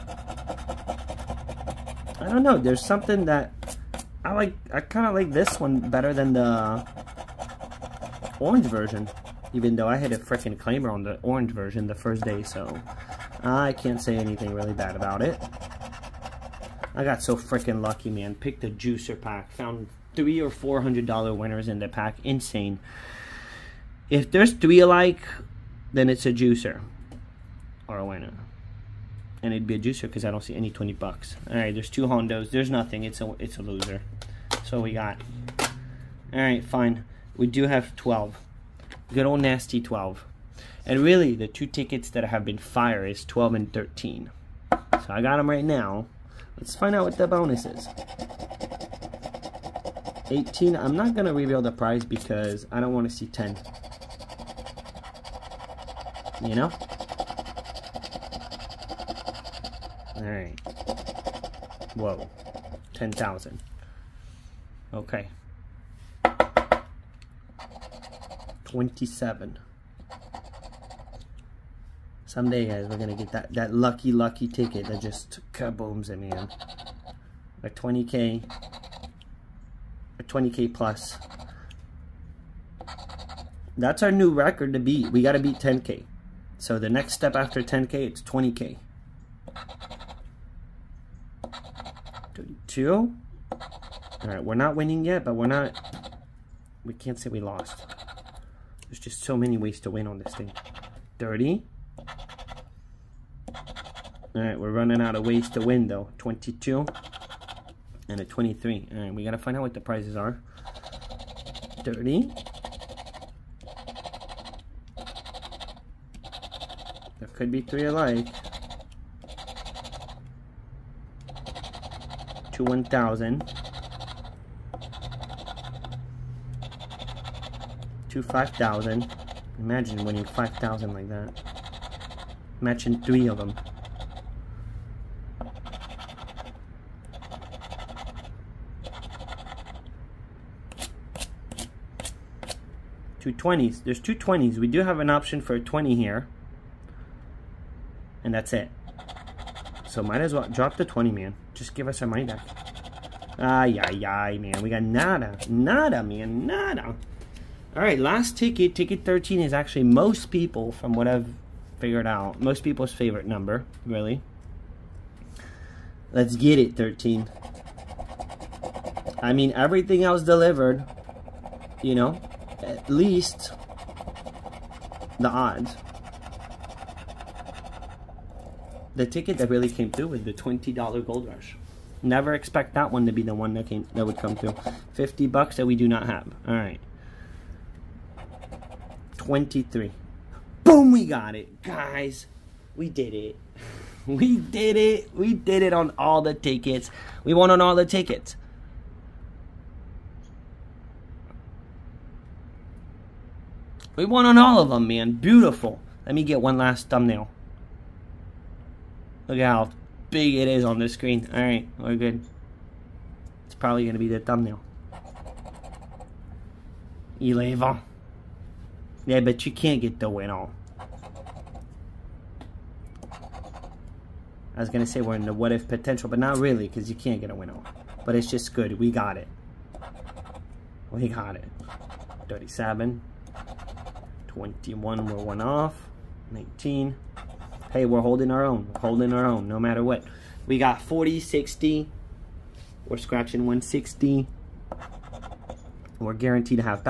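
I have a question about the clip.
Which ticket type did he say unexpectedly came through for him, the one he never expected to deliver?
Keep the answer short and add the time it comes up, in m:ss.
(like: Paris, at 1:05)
$20 gold rush, at 3:00.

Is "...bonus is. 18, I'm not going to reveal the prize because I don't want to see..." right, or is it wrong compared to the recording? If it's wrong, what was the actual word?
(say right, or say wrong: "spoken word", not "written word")
right.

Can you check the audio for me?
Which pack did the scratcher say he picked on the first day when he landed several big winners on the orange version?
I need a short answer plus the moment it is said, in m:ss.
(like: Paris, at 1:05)
The juicer pack, at 0:18.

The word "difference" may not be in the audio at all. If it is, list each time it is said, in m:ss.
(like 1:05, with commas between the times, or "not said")
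not said.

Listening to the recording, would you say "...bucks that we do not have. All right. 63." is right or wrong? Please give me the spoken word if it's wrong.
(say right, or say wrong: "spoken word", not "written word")
wrong: "23", not "63".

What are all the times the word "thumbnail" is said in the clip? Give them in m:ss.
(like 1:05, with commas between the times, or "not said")
3:26, 3:34.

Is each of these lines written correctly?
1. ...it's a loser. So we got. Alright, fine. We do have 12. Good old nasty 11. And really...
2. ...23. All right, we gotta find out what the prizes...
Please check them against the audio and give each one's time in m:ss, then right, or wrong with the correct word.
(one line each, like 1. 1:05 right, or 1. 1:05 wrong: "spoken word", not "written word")
1. 0:33 wrong: "12", not "11"
2. 1:48 right.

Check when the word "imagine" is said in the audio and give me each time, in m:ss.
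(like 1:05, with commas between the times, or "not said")
2:09.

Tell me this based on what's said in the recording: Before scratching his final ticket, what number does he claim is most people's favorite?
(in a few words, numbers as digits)
13.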